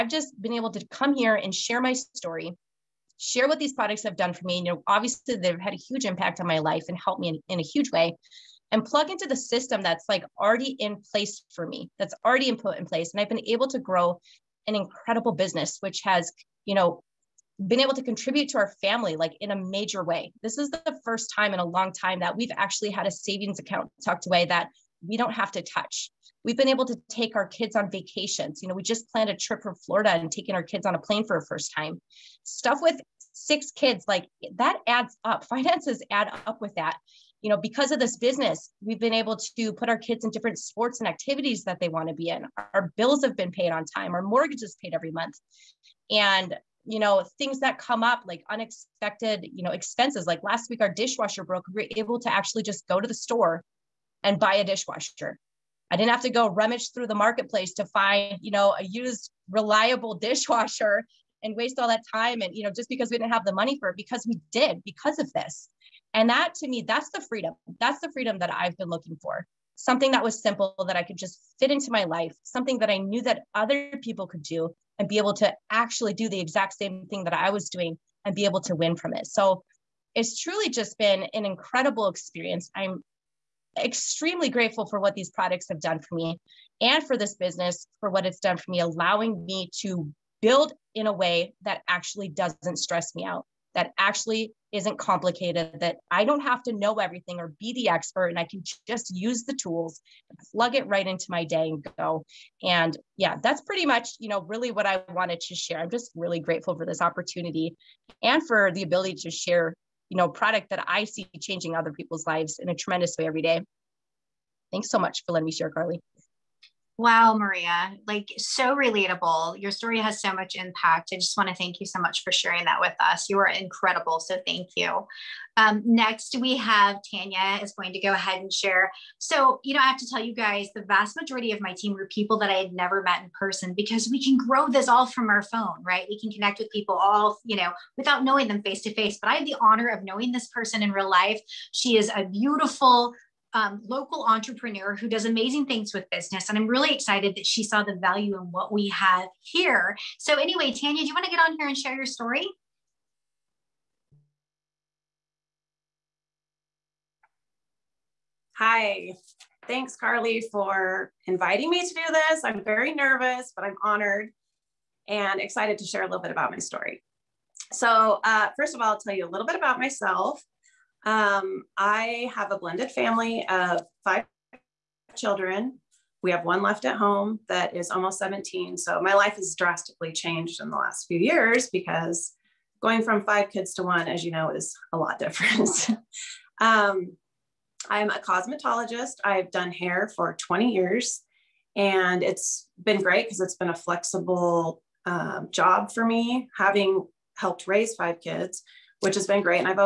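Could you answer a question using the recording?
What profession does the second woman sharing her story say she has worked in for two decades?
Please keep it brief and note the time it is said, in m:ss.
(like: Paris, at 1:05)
Cosmetologist, at 3:08.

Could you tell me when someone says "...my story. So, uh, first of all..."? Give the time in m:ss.
2:46.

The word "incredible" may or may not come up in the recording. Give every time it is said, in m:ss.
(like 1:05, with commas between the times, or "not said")
0:14, 1:21, 2:03.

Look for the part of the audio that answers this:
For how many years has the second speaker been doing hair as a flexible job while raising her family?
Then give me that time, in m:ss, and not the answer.
3:10.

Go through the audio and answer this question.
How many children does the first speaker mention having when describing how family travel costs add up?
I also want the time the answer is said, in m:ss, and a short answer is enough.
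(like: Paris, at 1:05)
6, at 0:33.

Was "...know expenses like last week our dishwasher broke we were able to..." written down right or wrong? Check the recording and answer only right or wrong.
right.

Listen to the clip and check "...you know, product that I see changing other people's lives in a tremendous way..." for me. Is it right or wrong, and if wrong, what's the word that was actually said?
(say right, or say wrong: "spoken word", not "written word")
right.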